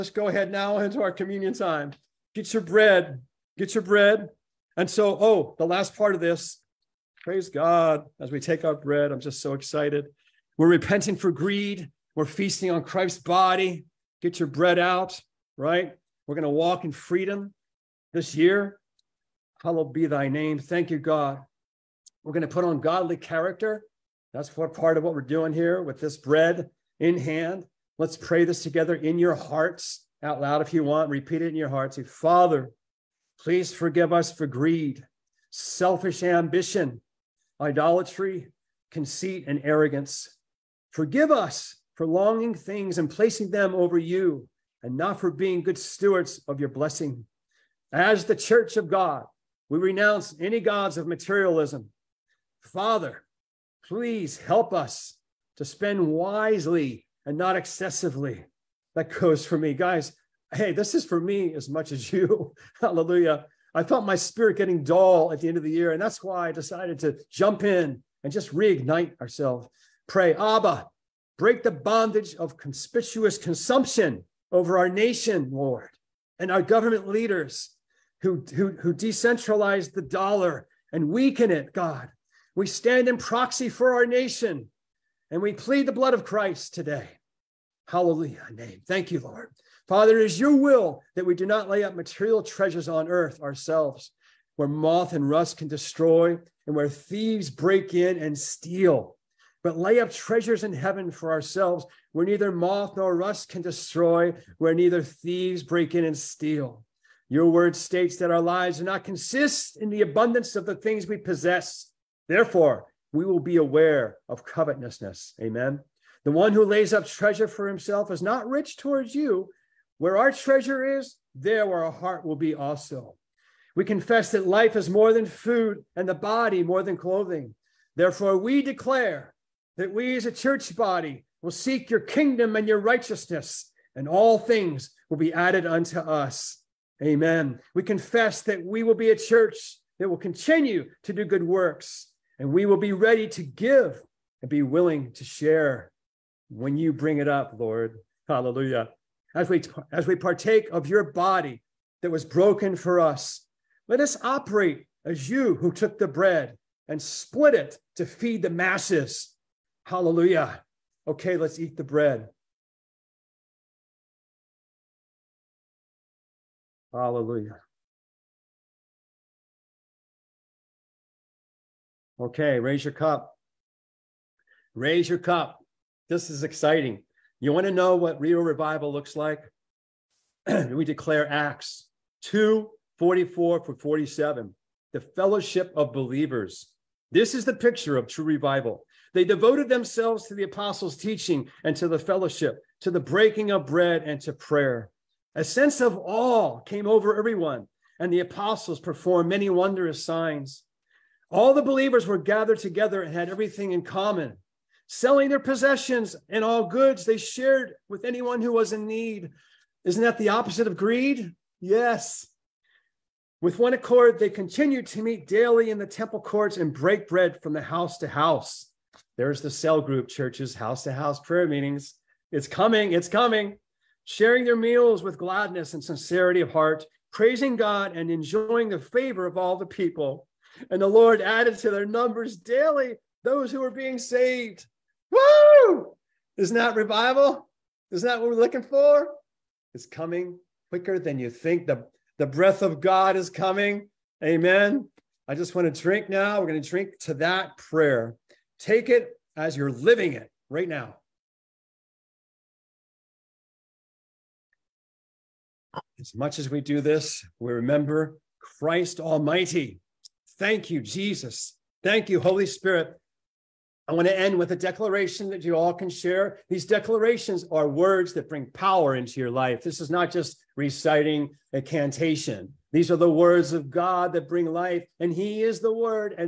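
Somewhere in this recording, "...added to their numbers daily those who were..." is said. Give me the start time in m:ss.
3:51.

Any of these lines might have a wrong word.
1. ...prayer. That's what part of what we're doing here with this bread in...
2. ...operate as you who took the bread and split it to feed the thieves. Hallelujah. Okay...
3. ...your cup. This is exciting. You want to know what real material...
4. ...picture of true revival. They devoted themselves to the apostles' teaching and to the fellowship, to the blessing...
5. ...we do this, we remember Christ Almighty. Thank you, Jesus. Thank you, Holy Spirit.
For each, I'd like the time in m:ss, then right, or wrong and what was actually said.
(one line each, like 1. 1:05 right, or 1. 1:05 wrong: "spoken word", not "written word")
1. 0:23 wrong: "character", not "prayer"
2. 2:34 wrong: "masses", not "thieves"
3. 2:55 wrong: "revival", not "material"
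4. 3:07 wrong: "breaking", not "blessing"
5. 4:16 right.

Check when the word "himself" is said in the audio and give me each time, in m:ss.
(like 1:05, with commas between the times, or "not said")
1:57.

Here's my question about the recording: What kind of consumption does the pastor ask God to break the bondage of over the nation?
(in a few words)
Conspicuous consumption.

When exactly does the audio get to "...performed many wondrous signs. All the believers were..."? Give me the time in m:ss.
3:18.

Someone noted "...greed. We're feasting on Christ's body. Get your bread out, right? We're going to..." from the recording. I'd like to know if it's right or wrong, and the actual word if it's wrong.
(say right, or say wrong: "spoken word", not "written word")
right.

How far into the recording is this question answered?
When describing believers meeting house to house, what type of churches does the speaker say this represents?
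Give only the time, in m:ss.
3:39.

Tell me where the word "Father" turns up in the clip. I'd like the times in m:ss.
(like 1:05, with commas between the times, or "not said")
0:32, 0:52, 1:29.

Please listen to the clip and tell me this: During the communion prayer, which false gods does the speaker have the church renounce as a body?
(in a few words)
Gods of materialism.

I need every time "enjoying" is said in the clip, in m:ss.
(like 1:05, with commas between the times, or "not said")
3:48.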